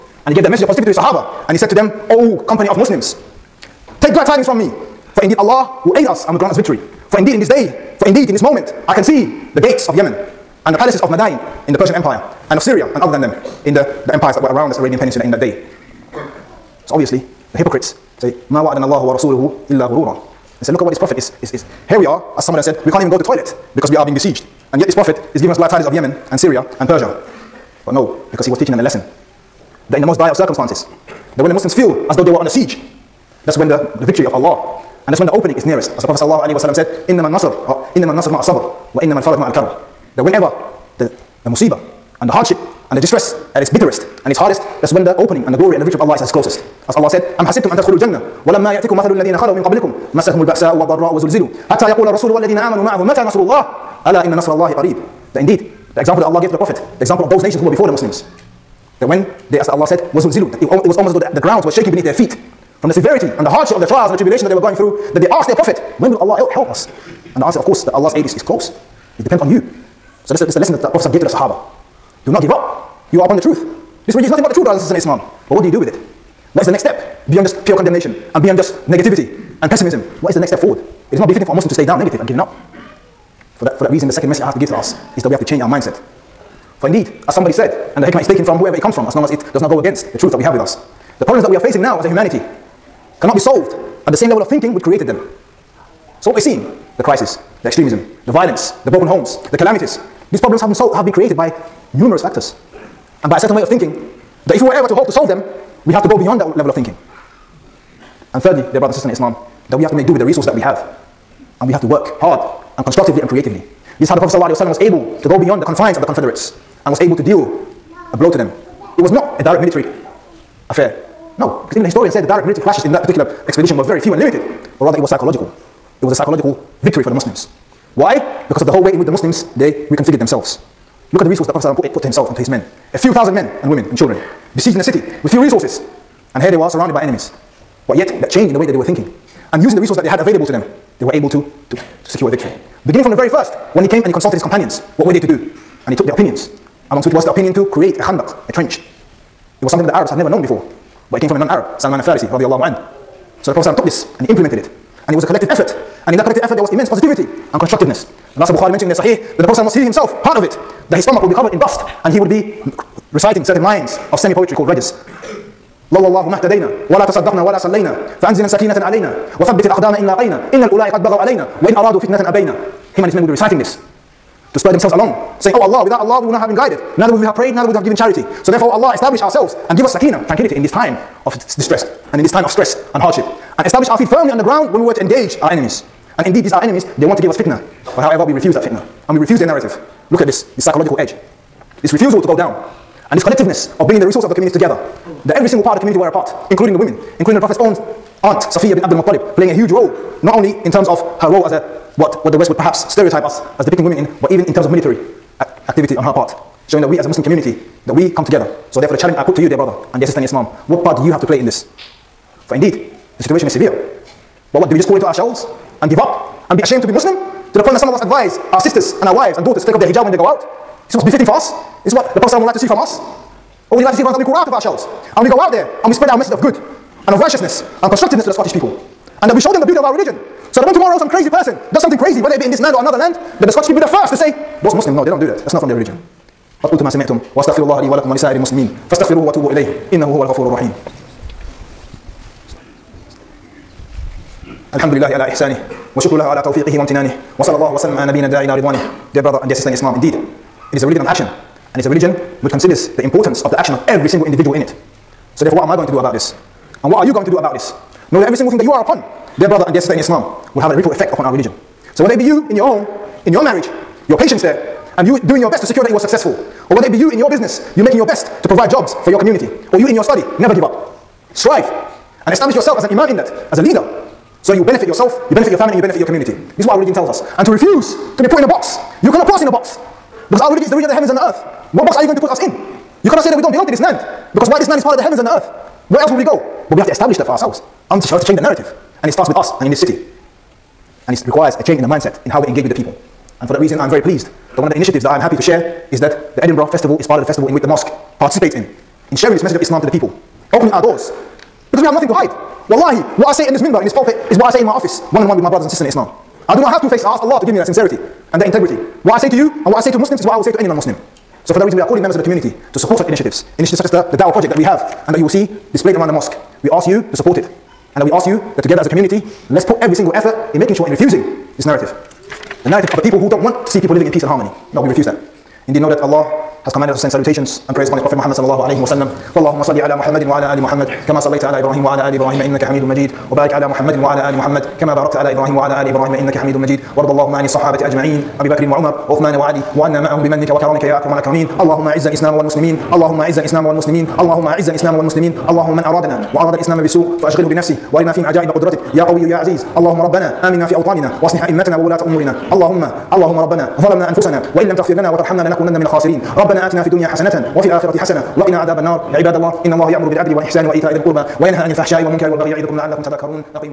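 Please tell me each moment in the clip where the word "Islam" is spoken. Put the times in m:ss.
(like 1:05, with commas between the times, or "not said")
1:14, 1:49, 3:30, 4:09, 4:19, 4:59, 5:05.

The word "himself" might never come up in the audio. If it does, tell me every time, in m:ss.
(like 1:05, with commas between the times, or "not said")
2:12, 2:39.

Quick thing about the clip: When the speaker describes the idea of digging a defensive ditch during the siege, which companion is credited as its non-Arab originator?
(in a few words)
Salman al-Farisi.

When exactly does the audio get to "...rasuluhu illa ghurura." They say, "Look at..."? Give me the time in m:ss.
0:19.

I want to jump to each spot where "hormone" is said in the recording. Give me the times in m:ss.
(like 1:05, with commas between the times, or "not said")
not said.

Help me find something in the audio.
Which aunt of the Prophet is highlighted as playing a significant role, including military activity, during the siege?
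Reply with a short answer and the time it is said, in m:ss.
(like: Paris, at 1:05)
Safiya bin Abdul Muttalib, at 3:18.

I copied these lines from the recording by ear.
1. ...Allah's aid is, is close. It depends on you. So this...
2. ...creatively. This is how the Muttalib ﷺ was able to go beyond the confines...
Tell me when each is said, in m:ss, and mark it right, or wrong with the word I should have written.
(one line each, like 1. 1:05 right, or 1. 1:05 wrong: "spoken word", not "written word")
1. 1:07 right
2. 1:53 wrong: "Prophet", not "Muttalib".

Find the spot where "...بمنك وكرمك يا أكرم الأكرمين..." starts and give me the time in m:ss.
5:40.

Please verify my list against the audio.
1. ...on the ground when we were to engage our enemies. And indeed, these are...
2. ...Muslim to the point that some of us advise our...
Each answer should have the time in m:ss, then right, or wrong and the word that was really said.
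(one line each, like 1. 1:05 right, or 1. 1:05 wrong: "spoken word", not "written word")
1. 3:04 right
2. 3:36 right.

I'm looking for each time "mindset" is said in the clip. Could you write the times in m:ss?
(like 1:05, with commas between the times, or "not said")
1:25, 4:51.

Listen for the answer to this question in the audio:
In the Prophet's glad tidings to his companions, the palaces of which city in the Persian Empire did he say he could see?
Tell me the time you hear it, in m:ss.
0:11.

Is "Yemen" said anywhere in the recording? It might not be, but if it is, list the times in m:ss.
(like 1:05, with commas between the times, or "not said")
0:09, 0:25.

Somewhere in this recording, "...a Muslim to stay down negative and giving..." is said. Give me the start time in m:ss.
1:21.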